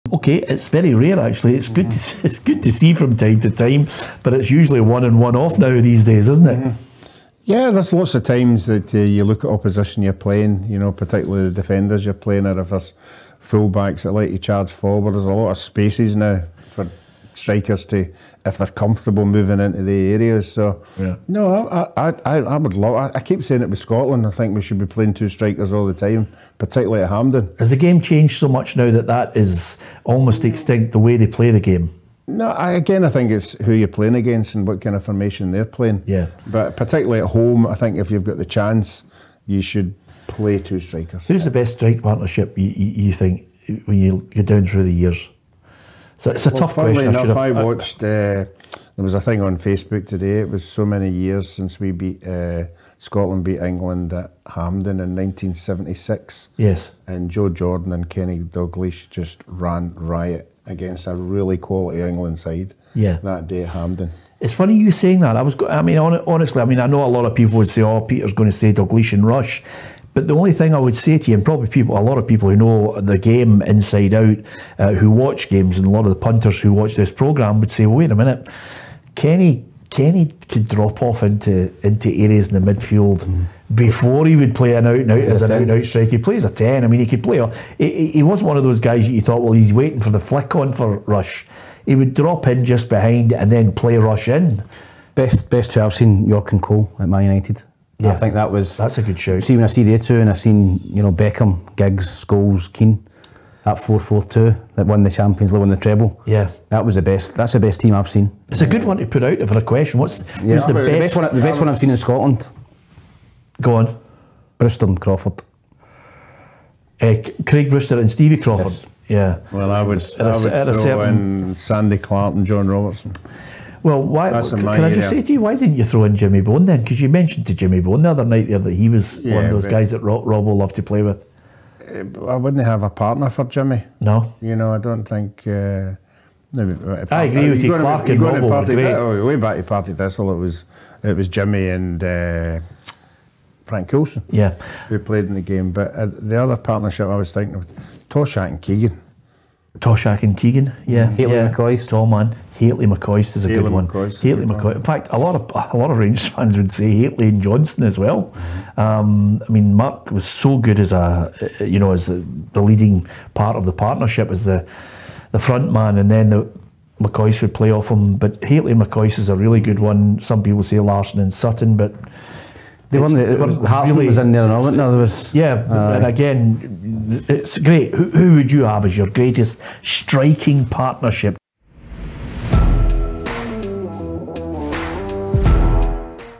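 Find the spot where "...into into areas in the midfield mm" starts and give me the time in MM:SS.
01:21.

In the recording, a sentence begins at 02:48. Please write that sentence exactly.
But Hateley McCoist is a really good one.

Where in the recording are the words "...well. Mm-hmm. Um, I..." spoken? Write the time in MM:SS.
02:37.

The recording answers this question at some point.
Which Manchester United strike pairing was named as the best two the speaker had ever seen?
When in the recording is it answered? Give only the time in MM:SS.
01:36.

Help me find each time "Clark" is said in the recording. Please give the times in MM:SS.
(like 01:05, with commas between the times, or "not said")
02:01, 02:17.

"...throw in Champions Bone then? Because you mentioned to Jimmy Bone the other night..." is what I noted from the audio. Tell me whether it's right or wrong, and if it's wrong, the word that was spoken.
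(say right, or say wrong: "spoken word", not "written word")
wrong: "Jimmy", not "Champions".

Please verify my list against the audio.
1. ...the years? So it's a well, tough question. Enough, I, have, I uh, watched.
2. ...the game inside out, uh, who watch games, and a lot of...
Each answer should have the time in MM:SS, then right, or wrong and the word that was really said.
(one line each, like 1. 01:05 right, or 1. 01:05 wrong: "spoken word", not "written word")
1. 00:44 right
2. 01:12 right.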